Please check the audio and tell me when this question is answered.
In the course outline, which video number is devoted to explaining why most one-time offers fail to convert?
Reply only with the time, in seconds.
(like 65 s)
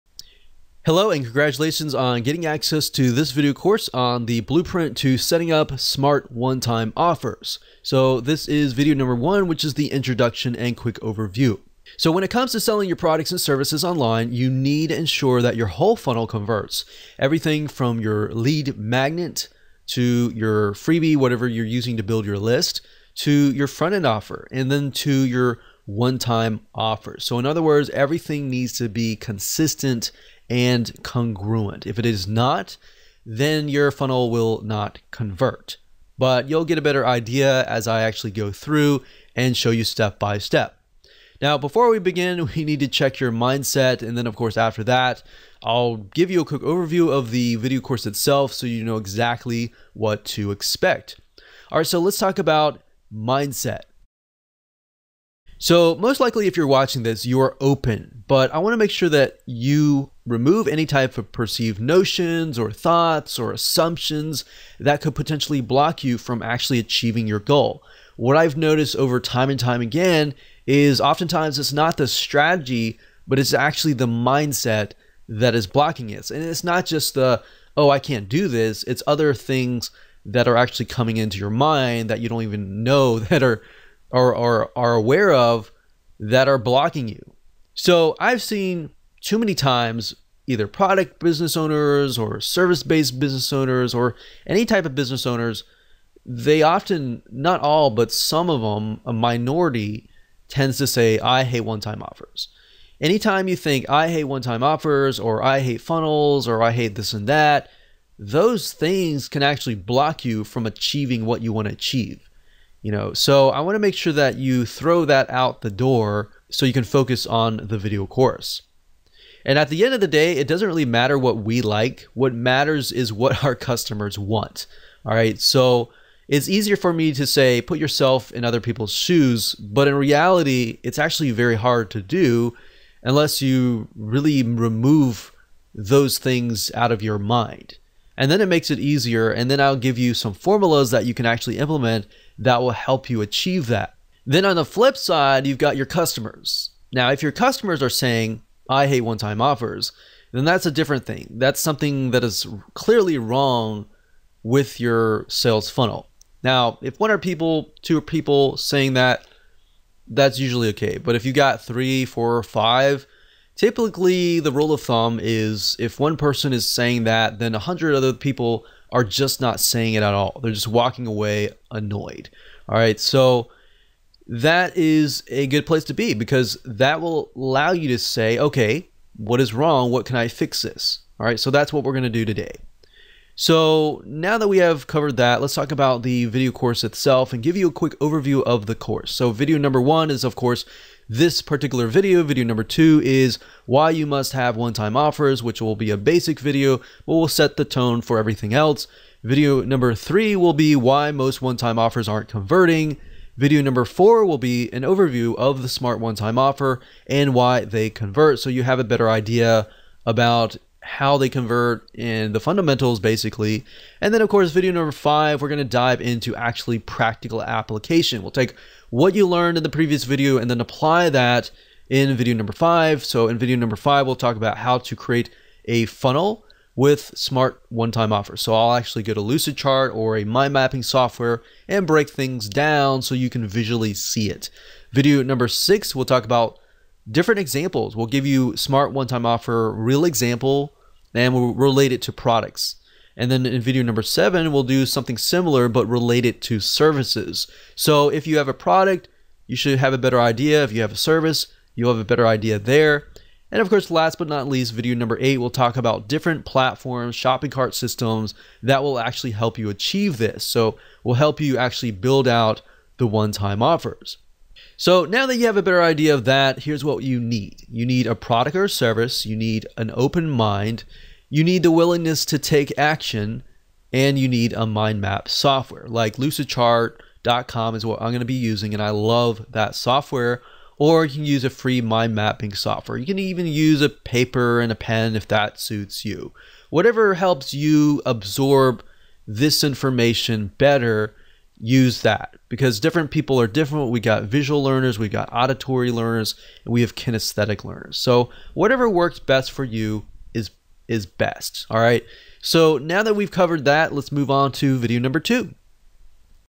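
199 s.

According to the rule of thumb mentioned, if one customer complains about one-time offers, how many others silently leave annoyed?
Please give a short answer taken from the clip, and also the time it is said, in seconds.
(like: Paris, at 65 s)
100, at 167 s.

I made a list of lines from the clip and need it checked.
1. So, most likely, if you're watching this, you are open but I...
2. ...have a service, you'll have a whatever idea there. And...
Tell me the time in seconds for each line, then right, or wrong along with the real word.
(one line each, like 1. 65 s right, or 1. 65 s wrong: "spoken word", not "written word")
1. 55 s right
2. 250 s wrong: "better", not "whatever".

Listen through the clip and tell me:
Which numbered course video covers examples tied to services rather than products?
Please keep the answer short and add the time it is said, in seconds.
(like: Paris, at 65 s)
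7, at 243 s.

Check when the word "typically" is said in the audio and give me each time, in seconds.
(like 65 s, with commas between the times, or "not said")
163 s.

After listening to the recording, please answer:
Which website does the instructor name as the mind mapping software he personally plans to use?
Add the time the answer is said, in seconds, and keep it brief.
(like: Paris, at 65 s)
lucidchart.com, at 276 s.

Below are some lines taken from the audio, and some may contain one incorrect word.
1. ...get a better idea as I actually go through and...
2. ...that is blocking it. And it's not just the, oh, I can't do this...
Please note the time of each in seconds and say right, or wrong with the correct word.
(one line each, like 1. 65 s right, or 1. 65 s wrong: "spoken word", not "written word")
1. 36 s right
2. 75 s right.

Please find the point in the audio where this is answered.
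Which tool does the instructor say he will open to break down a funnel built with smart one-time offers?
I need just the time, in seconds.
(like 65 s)
229 s.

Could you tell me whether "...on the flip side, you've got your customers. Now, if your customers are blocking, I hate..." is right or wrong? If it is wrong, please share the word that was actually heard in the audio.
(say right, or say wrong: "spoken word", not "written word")
wrong: "saying", not "blocking".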